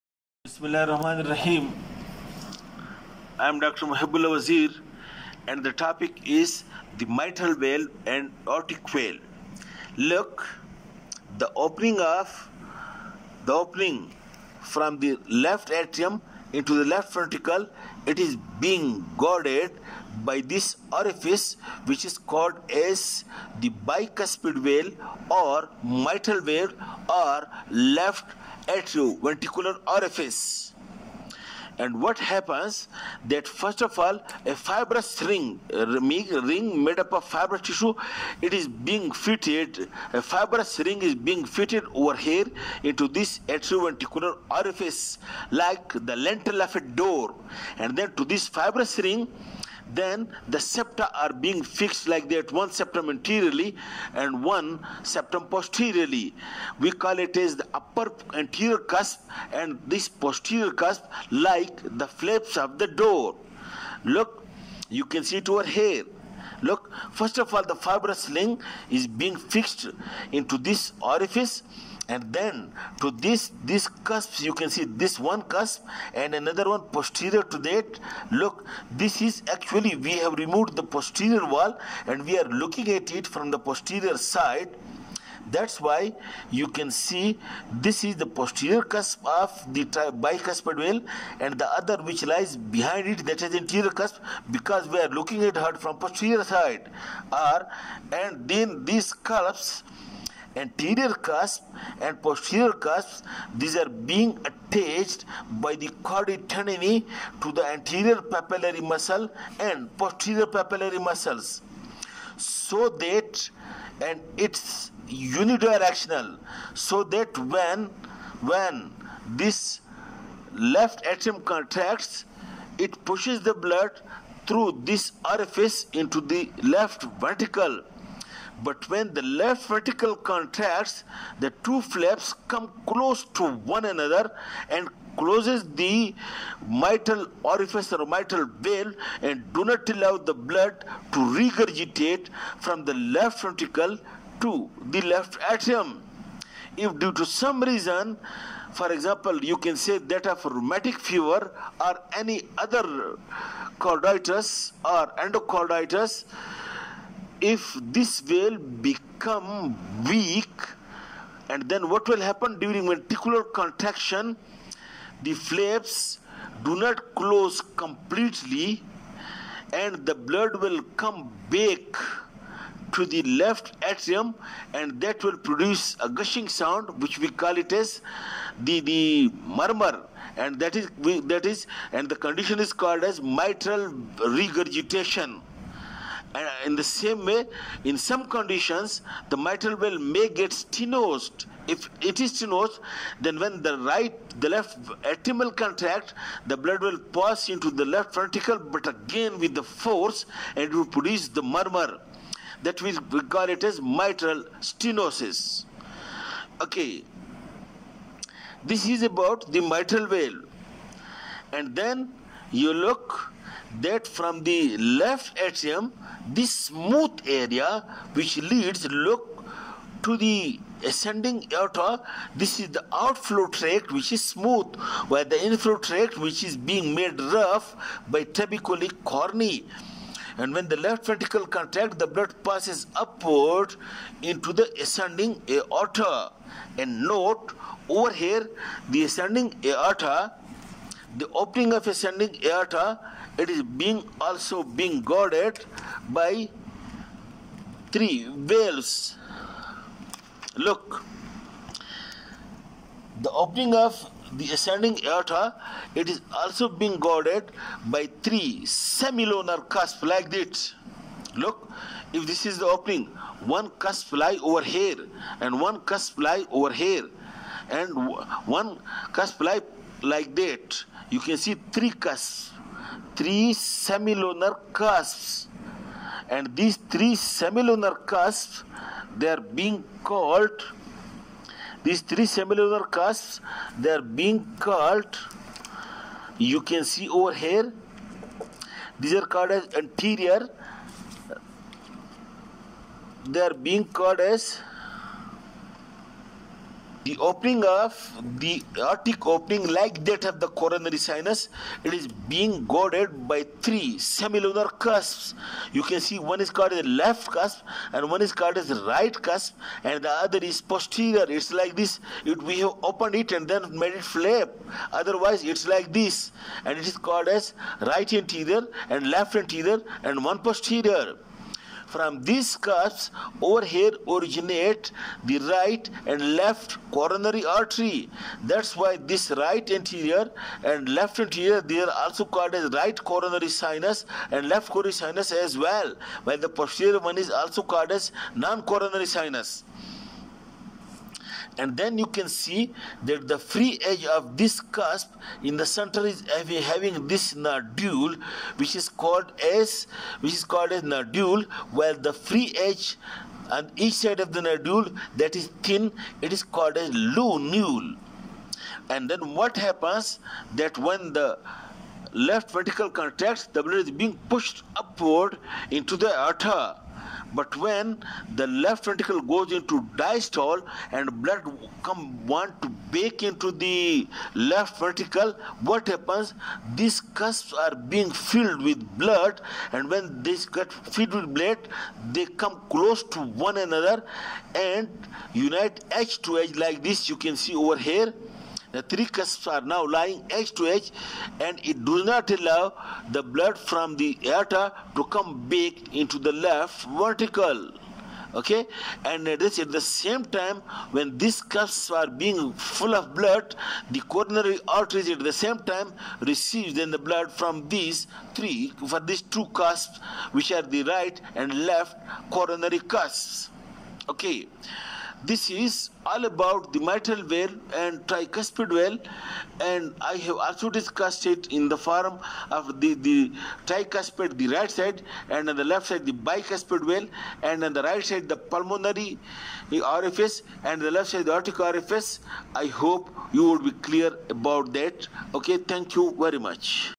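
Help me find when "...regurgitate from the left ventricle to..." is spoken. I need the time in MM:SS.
02:21.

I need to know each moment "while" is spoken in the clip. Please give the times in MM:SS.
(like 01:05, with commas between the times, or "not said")
05:36, 05:51.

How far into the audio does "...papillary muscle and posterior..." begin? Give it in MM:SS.
01:48.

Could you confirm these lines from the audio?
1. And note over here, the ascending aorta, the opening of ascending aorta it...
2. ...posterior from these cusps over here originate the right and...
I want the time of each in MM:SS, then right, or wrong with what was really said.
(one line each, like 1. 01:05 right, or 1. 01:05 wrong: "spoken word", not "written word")
1. 03:56 right
2. 05:20 right.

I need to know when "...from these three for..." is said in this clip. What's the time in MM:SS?
06:47.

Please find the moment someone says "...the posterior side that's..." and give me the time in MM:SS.
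01:23.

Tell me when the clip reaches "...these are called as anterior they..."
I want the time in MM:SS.
04:48.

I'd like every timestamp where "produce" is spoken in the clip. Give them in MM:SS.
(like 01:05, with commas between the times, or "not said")
02:55, 03:20.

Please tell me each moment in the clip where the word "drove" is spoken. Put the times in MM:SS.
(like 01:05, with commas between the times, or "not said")
not said.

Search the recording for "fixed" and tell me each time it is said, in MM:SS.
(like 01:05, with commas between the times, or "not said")
00:51, 01:09.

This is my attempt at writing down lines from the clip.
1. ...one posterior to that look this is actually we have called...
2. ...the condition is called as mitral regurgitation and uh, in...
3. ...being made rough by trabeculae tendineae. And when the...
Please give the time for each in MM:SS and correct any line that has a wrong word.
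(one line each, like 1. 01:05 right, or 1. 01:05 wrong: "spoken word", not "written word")
1. 01:16 wrong: "removed", not "called"
2. 03:02 right
3. 03:46 wrong: "carneae", not "tendineae".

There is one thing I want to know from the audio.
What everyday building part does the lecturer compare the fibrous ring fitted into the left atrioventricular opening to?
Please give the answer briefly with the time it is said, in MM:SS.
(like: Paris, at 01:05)
Lintel of a door, at 00:46.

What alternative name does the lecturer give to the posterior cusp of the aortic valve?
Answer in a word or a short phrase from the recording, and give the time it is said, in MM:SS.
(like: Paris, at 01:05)
Non-coronary sinus, at 05:38.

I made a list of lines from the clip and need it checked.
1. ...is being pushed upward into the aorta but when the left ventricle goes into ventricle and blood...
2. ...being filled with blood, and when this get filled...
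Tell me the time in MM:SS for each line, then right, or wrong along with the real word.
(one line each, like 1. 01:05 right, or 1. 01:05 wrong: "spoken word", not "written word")
1. 06:03 wrong: "diastole", not "ventricle"
2. 06:17 right.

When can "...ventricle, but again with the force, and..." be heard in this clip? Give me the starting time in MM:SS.
03:18.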